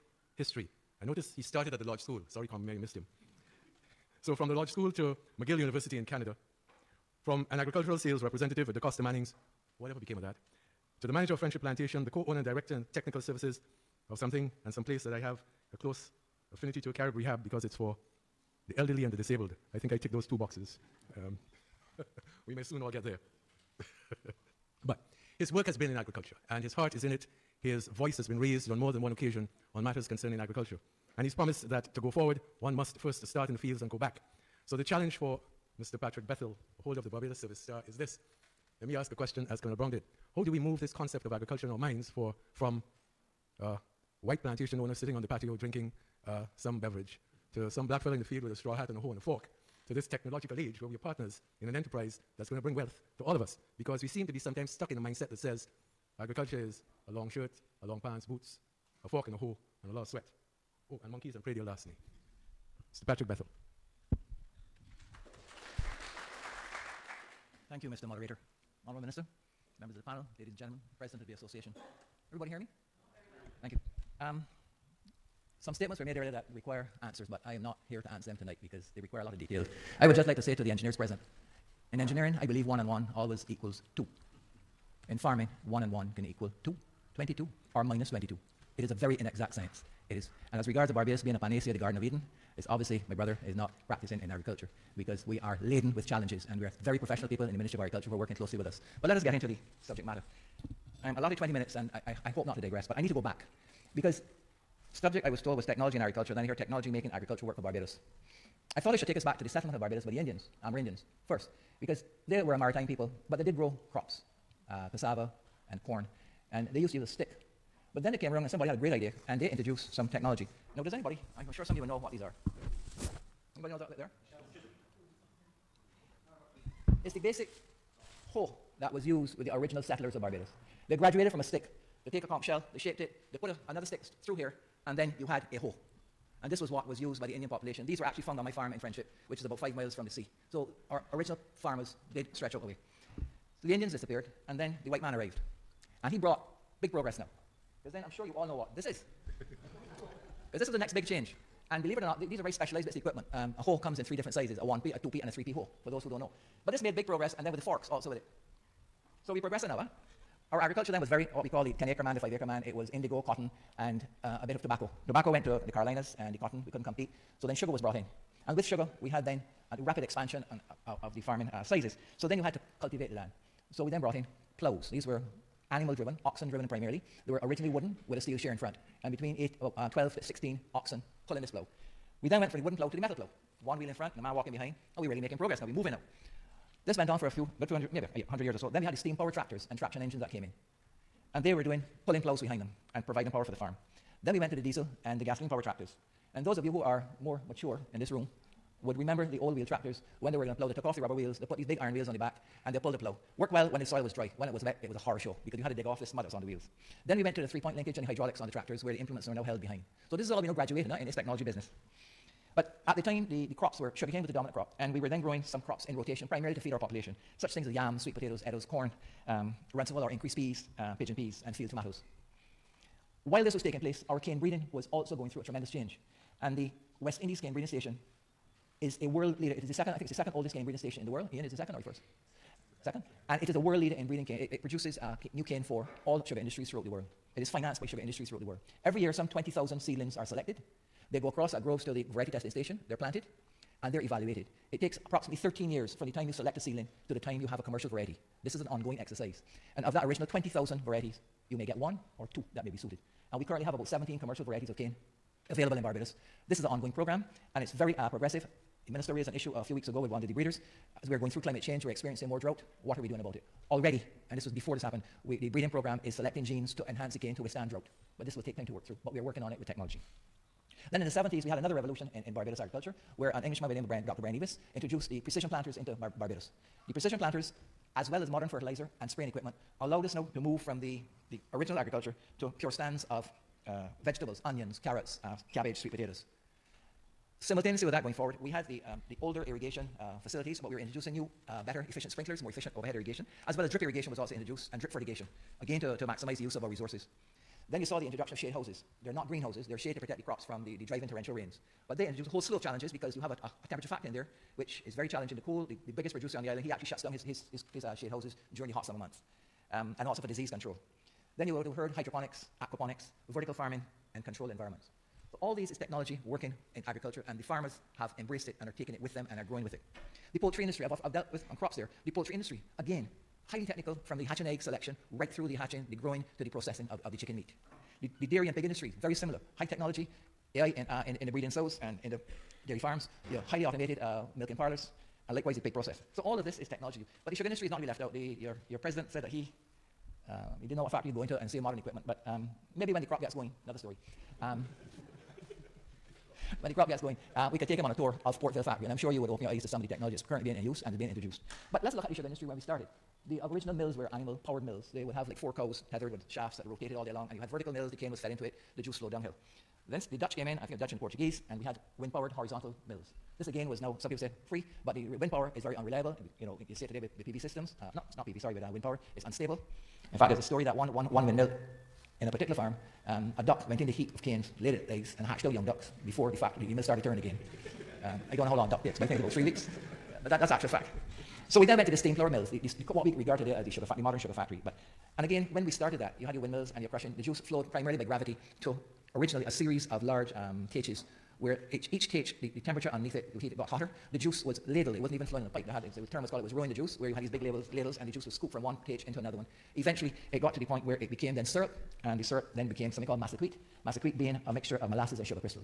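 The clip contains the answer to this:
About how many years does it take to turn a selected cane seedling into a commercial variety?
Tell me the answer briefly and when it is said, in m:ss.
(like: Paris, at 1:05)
13, at 4:05.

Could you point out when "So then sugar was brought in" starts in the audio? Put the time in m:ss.
2:47.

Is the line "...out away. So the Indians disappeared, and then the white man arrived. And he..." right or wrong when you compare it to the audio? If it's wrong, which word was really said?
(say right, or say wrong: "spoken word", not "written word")
right.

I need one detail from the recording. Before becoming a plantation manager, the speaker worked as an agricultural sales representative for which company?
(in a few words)
DaCosta Mannings.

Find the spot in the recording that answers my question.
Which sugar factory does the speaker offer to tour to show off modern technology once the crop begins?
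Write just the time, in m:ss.
5:48.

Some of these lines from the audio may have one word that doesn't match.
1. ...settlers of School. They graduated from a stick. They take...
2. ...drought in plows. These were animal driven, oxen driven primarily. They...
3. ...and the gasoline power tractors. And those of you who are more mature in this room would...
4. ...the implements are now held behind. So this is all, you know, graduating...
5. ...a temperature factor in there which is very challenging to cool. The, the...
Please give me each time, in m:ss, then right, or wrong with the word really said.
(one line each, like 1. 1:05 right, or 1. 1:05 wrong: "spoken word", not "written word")
1. 2:09 wrong: "Barbados", not "School"
2. 2:54 wrong: "brought", not "drought"
3. 3:15 right
4. 3:28 right
5. 5:03 right.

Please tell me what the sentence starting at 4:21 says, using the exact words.
As we are going through climate change, we're experiencing more drought.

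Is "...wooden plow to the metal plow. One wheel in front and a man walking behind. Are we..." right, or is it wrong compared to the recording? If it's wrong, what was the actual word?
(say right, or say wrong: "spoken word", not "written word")
right.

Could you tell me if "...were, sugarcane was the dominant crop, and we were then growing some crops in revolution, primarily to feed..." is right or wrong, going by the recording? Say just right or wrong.
wrong.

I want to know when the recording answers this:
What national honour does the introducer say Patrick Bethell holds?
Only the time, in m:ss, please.
0:37.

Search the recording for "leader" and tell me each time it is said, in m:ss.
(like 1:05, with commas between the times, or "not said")
3:49, 3:53.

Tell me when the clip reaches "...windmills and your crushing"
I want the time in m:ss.
6:26.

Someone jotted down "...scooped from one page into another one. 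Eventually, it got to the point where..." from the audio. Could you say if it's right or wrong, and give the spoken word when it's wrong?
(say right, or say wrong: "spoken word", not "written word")
right.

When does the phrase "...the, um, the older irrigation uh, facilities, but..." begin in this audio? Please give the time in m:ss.
4:48.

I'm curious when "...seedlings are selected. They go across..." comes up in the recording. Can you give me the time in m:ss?
3:59.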